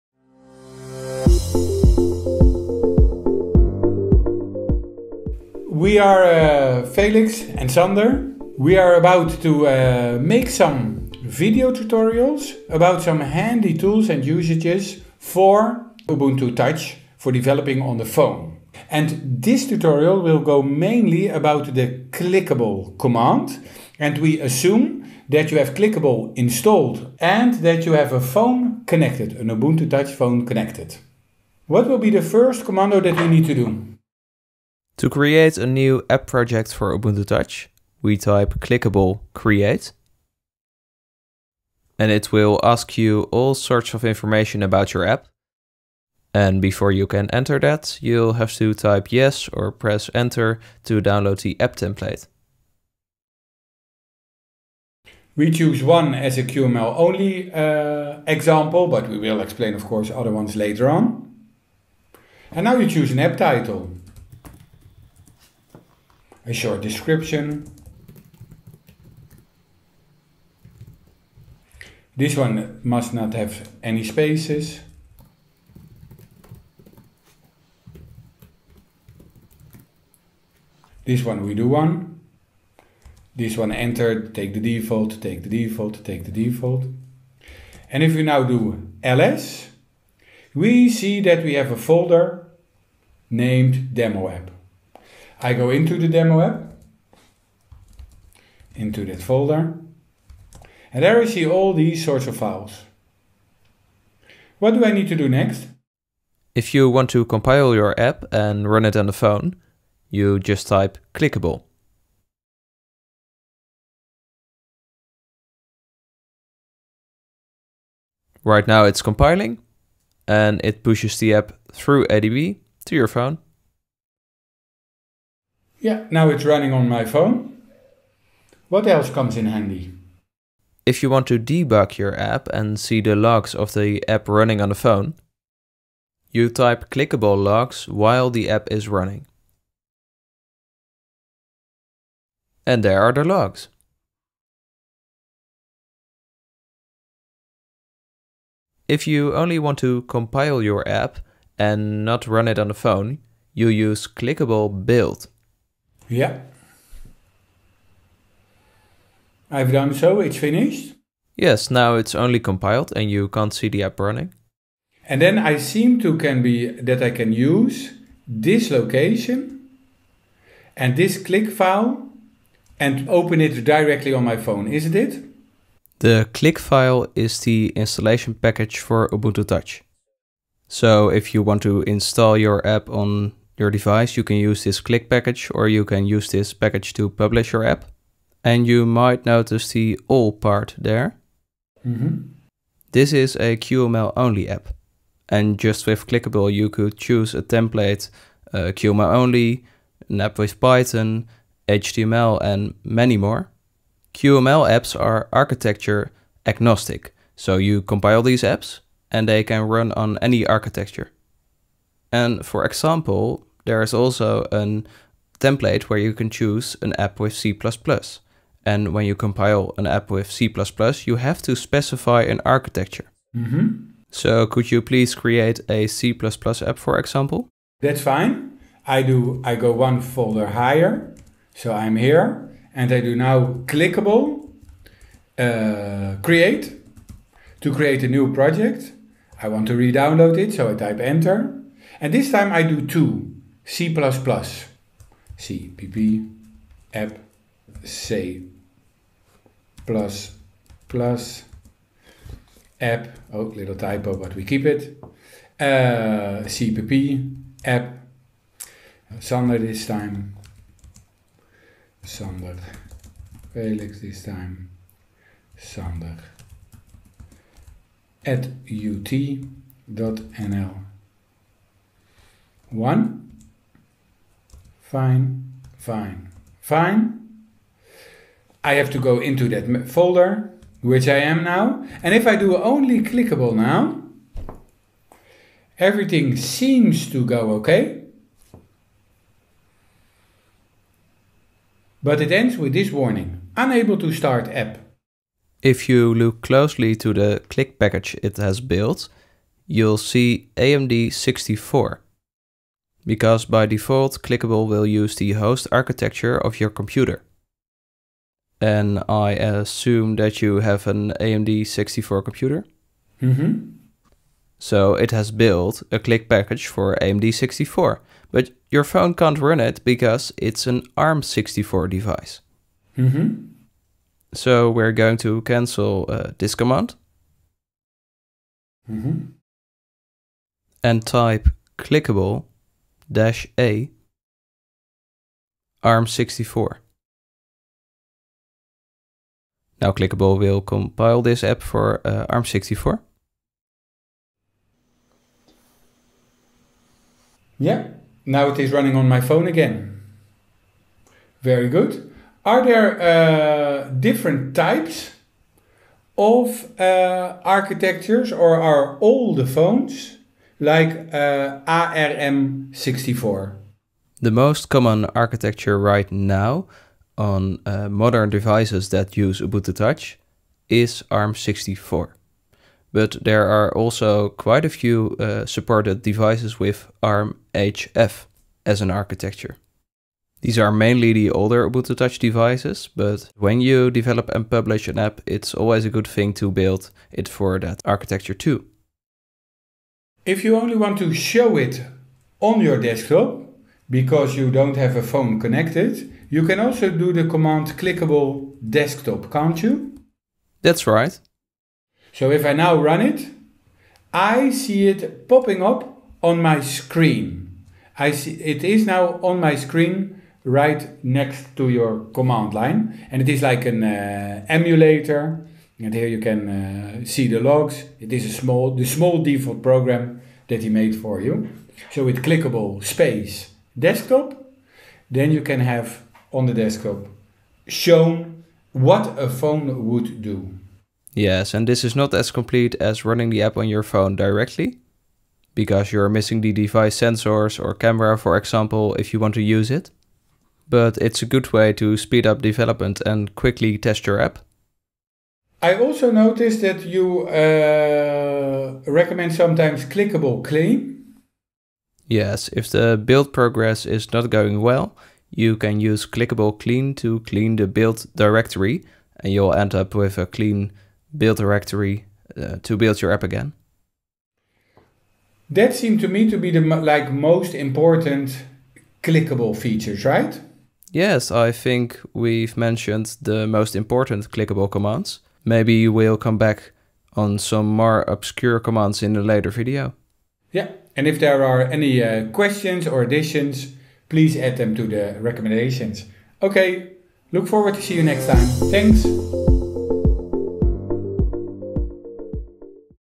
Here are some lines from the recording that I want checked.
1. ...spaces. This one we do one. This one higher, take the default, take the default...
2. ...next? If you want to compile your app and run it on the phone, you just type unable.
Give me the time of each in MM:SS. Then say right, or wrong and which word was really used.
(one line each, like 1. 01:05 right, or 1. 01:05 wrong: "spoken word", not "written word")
1. 01:14 wrong: "enter", not "higher"
2. 01:45 wrong: "clickable", not "unable".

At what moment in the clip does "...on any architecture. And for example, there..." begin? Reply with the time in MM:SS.
03:29.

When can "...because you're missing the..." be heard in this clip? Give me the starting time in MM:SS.
07:15.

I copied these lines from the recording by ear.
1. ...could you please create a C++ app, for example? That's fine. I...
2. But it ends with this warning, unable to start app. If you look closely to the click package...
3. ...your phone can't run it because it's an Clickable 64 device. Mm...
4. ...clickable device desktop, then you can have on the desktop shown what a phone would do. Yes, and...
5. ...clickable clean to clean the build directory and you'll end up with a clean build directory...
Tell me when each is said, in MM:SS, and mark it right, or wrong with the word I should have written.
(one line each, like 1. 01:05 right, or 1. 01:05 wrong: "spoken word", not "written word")
1. 03:44 right
2. 04:52 right
3. 05:18 wrong: "ARM", not "Clickable"
4. 07:02 wrong: "space", not "device"
5. 07:36 right.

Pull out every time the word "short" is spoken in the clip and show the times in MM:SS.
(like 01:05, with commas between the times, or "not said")
01:06.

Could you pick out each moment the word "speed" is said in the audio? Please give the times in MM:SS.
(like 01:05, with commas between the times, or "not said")
07:21.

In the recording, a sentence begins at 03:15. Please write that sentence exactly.
And just with clickable, you could choose a template, uh, QML only, an app with Python, HTML, and many more.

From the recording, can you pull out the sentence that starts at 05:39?
Now Clickable will compile this app for uh, eh, ARM64.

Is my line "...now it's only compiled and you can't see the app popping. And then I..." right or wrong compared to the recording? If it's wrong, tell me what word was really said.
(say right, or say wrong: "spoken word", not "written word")
wrong: "running", not "popping".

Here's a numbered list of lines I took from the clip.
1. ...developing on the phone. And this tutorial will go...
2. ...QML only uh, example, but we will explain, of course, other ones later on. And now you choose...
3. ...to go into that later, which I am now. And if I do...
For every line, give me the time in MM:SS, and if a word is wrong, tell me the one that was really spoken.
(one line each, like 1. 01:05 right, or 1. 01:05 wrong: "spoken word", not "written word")
1. 00:17 right
2. 00:56 right
3. 04:38 wrong: "folder", not "later".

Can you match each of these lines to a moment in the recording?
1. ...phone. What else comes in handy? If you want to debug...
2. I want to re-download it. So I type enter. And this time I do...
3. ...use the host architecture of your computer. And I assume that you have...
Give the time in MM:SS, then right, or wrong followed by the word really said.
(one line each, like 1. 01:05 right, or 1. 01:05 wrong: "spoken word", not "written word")
1. 02:07 right
2. 03:59 right
3. 05:04 right.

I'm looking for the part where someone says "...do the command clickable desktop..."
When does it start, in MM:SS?
06:36.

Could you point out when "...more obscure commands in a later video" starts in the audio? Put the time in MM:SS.
07:57.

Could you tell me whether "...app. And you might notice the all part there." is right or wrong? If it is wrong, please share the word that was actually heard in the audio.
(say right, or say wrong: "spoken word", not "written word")
right.